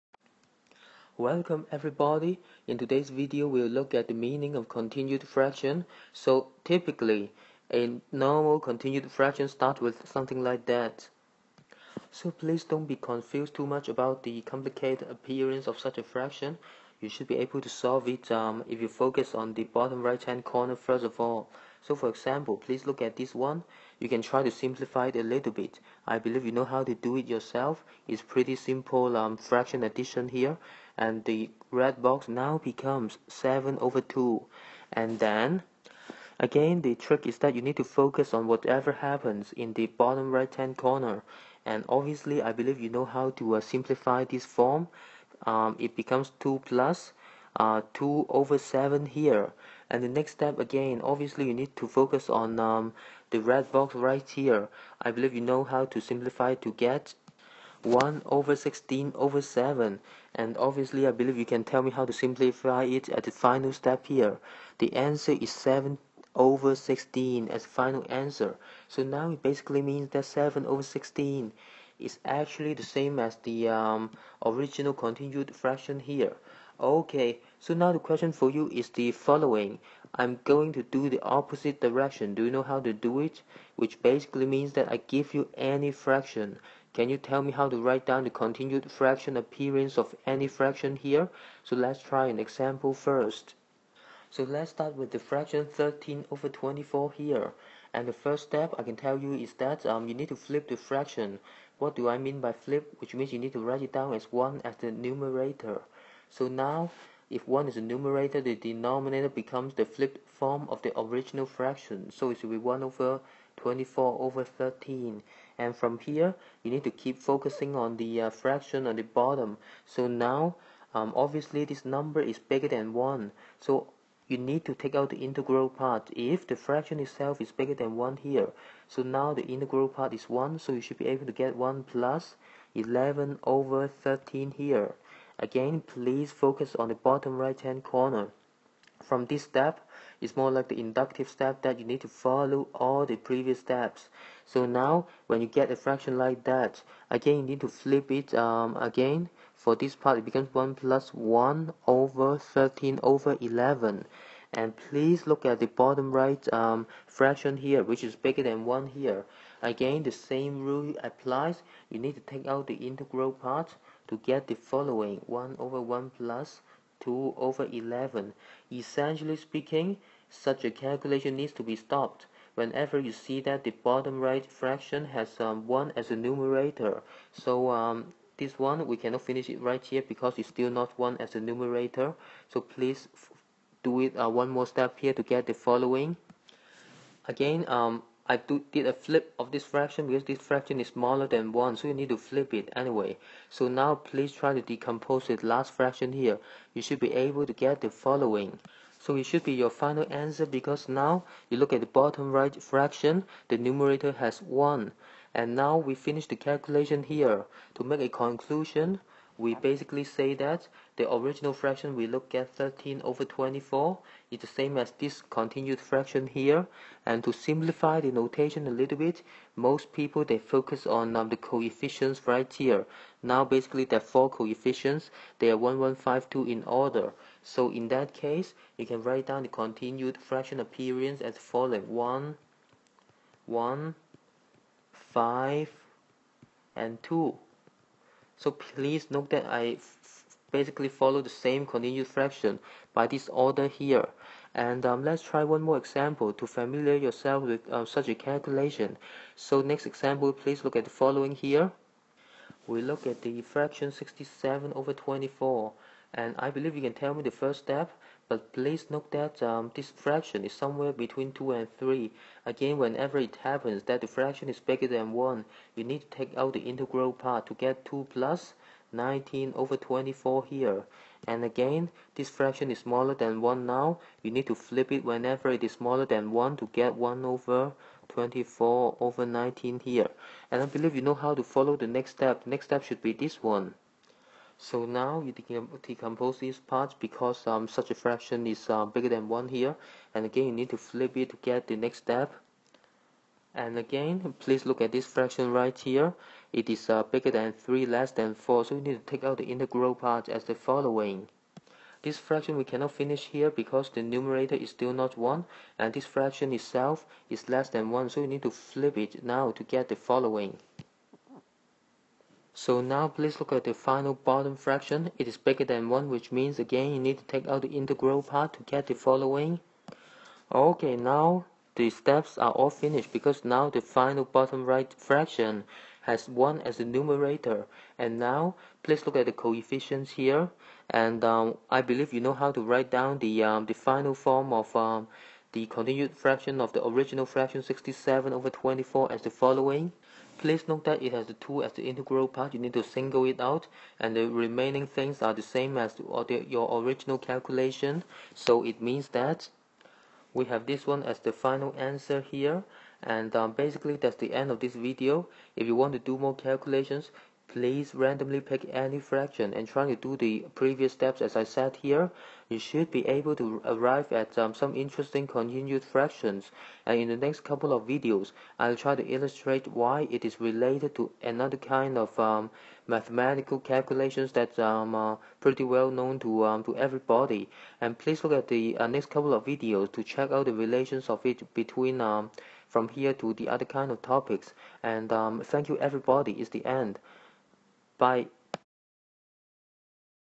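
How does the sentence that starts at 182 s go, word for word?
So please do it uh, one more step here to get the following.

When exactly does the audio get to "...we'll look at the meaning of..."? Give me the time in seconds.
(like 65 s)
3 s.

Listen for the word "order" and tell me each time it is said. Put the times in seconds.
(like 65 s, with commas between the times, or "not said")
226 s, 243 s.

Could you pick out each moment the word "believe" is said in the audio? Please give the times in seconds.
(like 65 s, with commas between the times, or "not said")
26 s, 42 s, 55 s, 61 s, 256 s, 280 s, 331 s.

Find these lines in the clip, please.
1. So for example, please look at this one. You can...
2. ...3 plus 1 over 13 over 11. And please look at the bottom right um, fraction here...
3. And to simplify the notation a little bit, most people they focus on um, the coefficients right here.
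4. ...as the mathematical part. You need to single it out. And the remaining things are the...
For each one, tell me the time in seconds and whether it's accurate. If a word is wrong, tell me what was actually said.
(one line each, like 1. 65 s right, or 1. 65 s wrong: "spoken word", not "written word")
1. 21 s right
2. 150 s wrong: "1", not "3"
3. 217 s right
4. 341 s wrong: "integral", not "mathematical".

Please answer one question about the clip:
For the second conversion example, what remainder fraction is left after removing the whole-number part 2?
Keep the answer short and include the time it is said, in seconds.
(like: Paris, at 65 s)
19/24, at 268 s.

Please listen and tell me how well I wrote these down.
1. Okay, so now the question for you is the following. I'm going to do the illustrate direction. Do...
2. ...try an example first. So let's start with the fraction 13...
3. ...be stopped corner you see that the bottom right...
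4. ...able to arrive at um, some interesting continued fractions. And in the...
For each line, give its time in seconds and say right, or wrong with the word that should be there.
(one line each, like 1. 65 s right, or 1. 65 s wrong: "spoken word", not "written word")
1. 76 s wrong: "opposite", not "illustrate"
2. 92 s right
3. 171 s wrong: "whenever", not "corner"
4. 363 s right.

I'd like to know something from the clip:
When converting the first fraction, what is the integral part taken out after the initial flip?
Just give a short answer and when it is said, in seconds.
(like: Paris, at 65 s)
1, at 129 s.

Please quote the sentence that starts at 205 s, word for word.
And now we finish the calculation here.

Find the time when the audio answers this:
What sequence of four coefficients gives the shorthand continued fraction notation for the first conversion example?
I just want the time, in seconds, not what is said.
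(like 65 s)
225 s.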